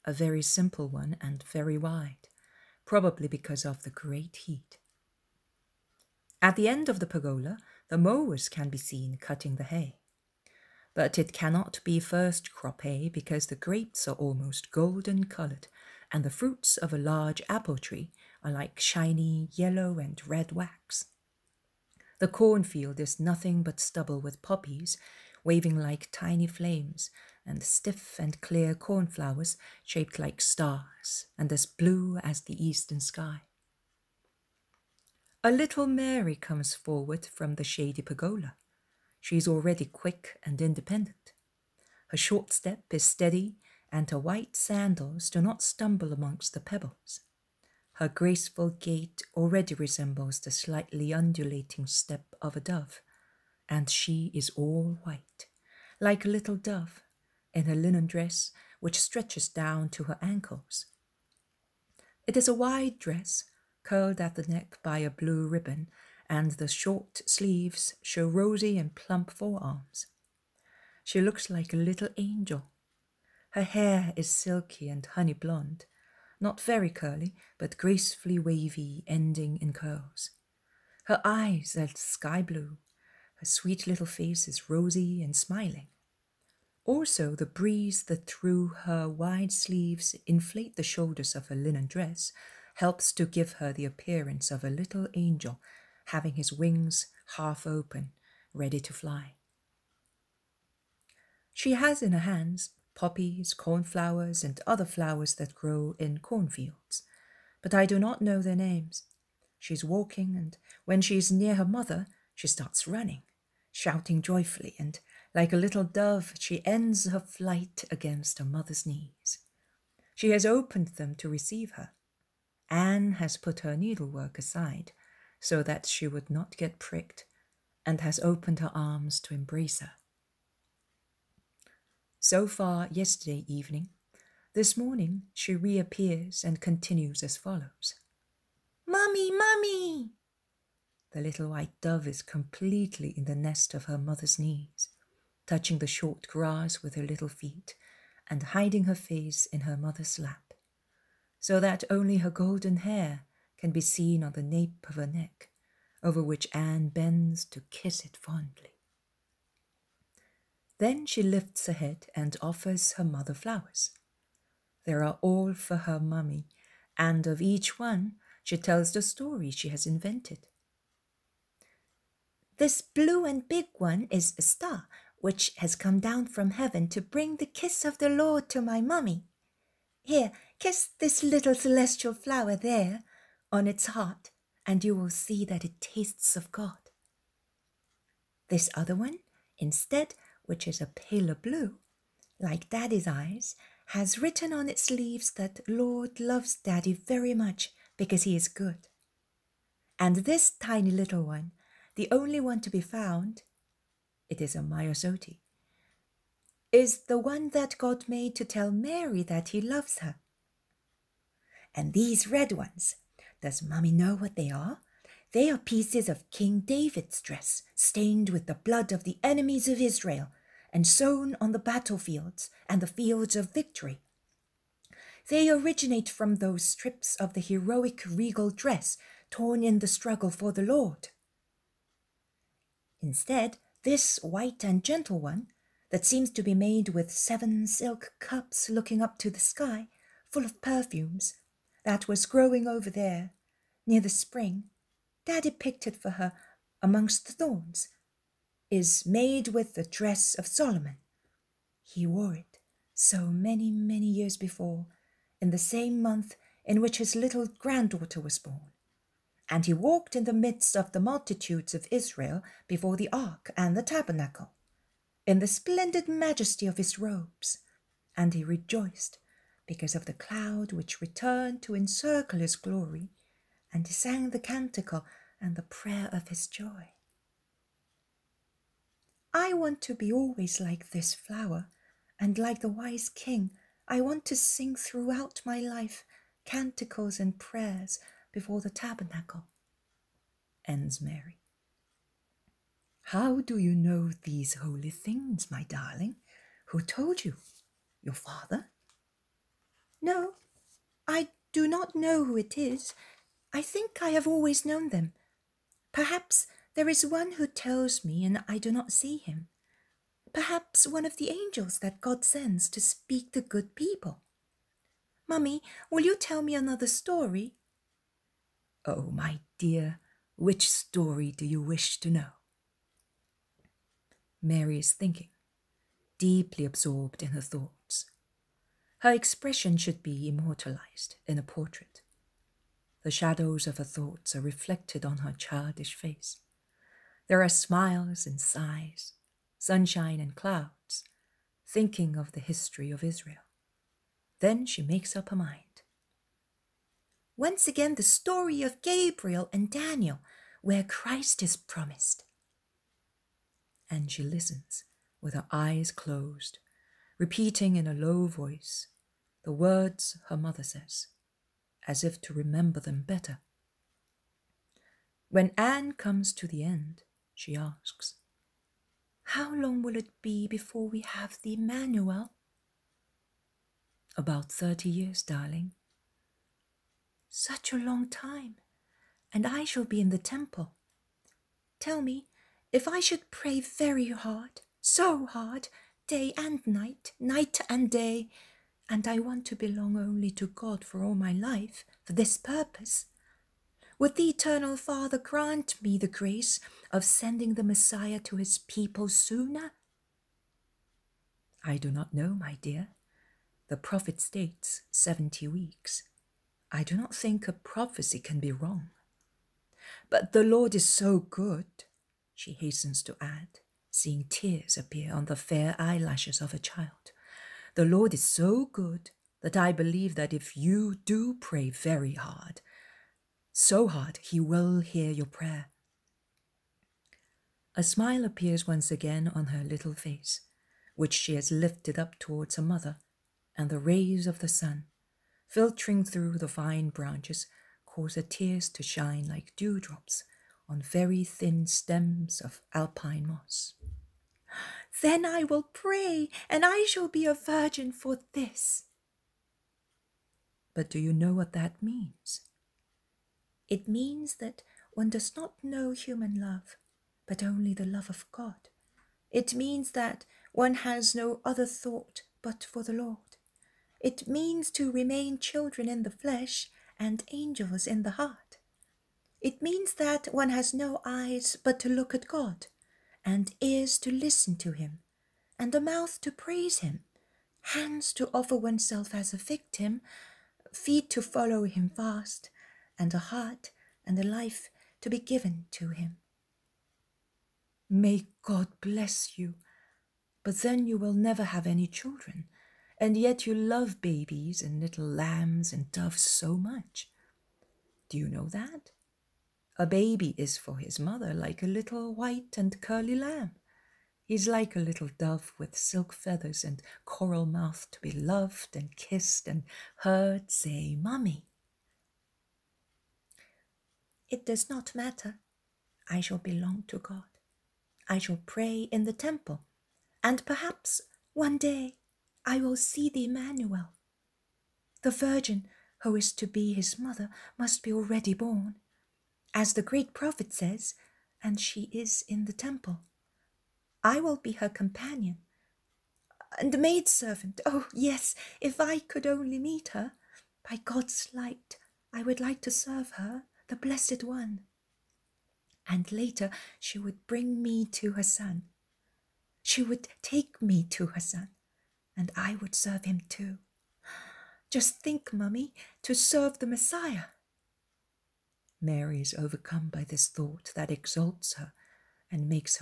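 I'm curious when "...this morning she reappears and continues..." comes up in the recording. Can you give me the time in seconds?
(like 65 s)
134 s.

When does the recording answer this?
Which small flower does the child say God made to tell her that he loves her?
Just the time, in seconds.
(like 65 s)
204 s.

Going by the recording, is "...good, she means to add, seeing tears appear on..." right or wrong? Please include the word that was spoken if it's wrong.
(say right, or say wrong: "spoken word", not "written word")
wrong: "hastens", not "means".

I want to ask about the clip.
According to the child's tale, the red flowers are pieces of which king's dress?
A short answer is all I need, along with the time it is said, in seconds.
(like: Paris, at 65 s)
King David, at 216 s.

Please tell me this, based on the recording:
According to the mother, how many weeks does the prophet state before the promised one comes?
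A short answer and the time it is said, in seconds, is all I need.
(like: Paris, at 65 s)
70, at 404 s.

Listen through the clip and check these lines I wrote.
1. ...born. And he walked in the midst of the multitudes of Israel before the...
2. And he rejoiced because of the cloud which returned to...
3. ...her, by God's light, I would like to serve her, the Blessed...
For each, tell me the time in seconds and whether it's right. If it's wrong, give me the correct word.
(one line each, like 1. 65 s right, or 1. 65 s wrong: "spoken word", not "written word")
1. 258 s right
2. 268 s right
3. 539 s right.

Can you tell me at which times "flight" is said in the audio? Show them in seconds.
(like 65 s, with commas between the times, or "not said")
117 s.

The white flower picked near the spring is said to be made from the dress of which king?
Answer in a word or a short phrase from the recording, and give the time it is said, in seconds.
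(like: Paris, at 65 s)
Solomon, at 250 s.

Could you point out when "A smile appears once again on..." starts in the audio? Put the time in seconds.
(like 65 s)
427 s.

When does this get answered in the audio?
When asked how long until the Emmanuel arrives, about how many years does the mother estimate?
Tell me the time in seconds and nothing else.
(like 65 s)
374 s.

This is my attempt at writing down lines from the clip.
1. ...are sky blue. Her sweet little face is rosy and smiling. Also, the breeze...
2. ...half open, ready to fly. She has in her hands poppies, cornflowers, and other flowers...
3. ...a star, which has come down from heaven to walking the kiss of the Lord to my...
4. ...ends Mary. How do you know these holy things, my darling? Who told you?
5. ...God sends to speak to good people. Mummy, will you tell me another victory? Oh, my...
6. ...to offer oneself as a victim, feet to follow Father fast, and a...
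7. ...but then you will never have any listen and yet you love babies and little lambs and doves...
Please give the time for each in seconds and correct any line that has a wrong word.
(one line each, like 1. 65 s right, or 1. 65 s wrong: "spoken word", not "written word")
1. 81 s right
2. 97 s right
3. 174 s wrong: "bring", not "walking"
4. 290 s right
5. 311 s wrong: "story", not "victory"
6. 478 s wrong: "Him", not "Father"
7. 490 s wrong: "children", not "listen".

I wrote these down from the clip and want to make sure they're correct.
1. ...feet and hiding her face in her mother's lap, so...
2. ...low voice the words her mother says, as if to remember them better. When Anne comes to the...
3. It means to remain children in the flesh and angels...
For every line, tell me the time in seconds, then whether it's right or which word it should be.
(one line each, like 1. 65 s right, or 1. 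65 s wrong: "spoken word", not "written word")
1. 147 s right
2. 357 s right
3. 464 s right.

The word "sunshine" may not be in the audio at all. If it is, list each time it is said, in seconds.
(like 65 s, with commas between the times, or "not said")
339 s.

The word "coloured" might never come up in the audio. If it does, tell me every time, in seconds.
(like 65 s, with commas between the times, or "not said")
15 s.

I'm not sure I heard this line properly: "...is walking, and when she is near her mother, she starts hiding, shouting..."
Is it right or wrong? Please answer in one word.
wrong.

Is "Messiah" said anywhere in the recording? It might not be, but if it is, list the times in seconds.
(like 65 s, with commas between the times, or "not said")
397 s, 556 s.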